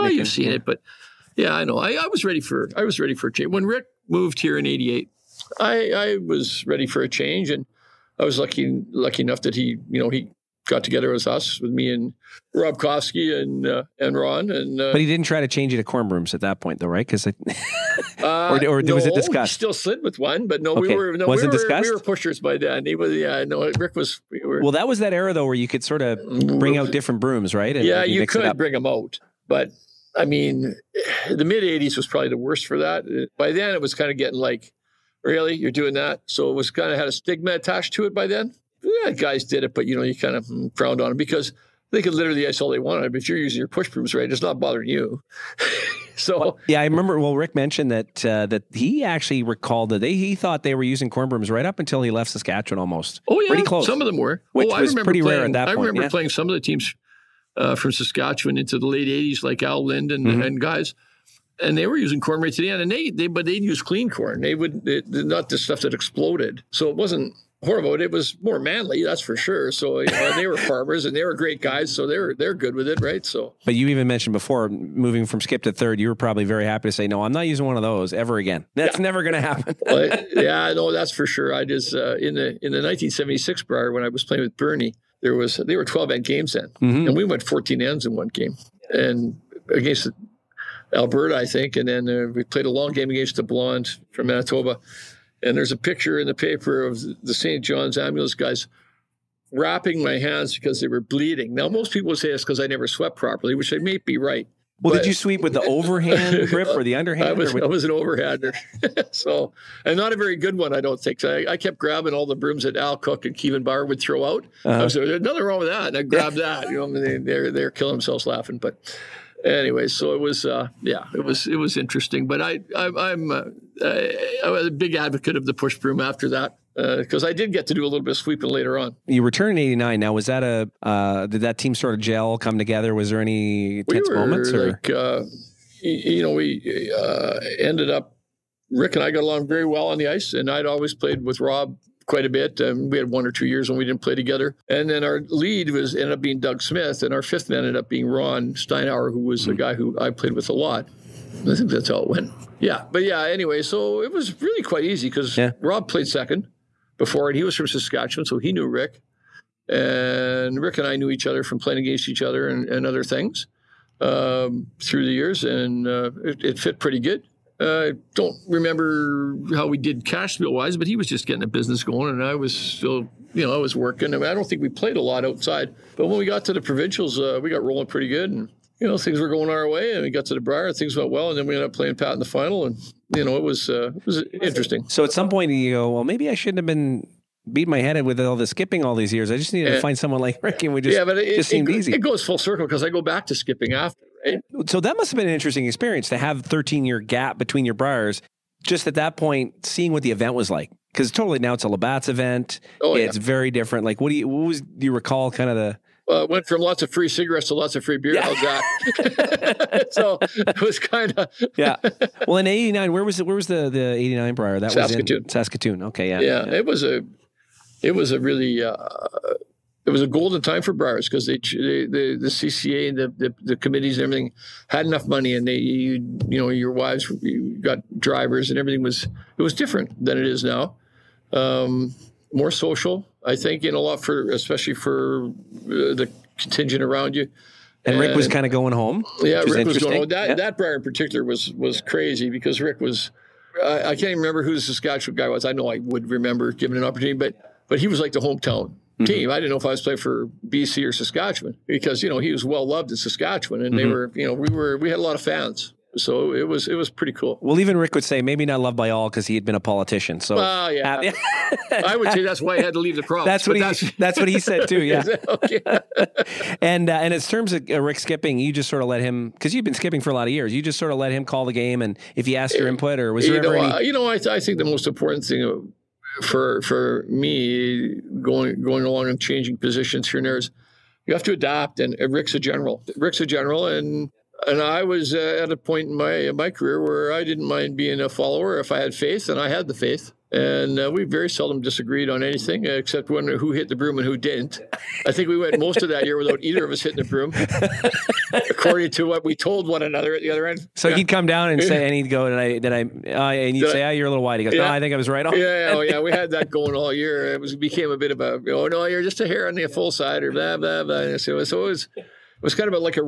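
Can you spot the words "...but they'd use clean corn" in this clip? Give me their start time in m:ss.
1:03.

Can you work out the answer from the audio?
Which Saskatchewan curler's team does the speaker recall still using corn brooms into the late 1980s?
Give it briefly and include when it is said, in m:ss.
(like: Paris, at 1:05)
Al Lind, at 0:59.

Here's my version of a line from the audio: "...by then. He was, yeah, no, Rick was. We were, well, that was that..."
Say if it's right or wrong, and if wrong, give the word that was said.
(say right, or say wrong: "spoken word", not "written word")
right.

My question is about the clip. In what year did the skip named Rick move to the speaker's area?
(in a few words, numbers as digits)
1988.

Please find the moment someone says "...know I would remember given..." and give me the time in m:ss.
4:05.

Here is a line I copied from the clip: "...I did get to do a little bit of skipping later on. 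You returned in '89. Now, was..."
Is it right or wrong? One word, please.
wrong.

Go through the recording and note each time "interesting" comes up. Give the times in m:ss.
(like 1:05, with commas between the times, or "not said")
2:01, 3:04, 3:15.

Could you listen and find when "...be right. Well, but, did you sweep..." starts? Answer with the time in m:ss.
1:43.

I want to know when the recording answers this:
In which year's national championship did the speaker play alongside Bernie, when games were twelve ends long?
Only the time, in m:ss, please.
1:22.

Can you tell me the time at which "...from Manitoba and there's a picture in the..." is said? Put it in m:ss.
1:34.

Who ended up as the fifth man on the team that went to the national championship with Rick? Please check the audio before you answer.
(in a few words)
Ron Steinauer.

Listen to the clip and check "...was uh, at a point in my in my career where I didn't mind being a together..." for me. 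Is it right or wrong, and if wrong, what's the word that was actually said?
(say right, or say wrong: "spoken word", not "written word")
wrong: "follower", not "together".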